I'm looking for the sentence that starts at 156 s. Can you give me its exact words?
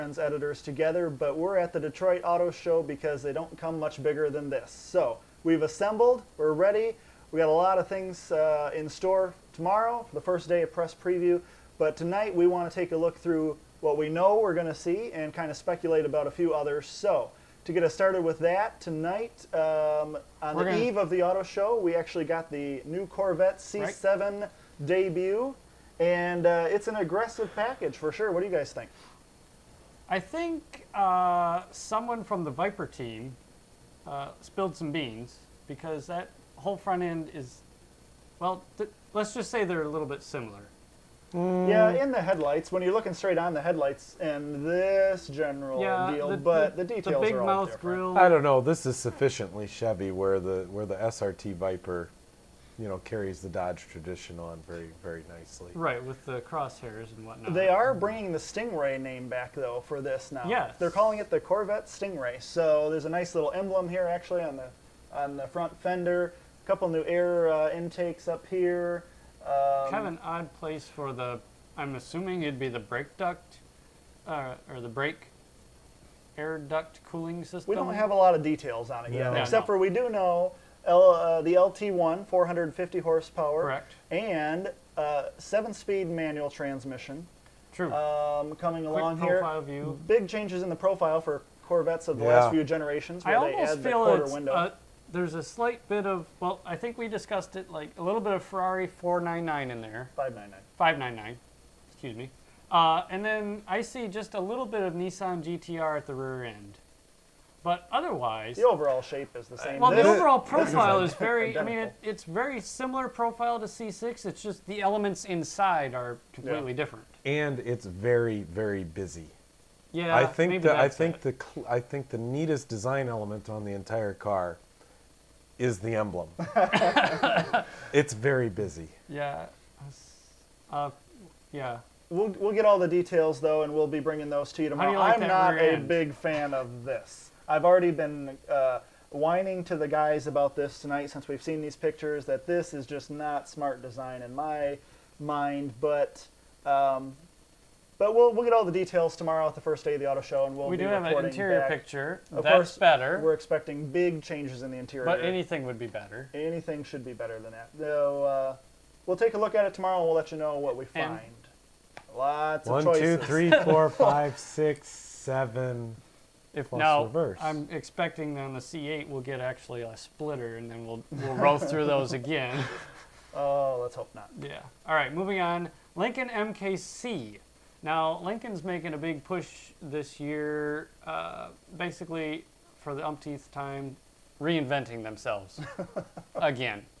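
Anything should be better than that.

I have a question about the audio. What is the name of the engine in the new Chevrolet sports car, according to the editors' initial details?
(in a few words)
LT1.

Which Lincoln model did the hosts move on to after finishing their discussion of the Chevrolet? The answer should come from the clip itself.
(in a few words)
MKC.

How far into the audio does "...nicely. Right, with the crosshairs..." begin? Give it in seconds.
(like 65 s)
55 s.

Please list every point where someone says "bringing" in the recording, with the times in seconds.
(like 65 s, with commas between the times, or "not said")
57 s, 133 s.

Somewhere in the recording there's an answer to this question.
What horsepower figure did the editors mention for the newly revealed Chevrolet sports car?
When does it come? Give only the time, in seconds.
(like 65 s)
82 s.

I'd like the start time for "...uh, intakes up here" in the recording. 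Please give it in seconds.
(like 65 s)
67 s.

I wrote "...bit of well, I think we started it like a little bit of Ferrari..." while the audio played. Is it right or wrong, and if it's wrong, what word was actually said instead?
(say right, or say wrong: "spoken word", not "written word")
wrong: "discussed", not "started".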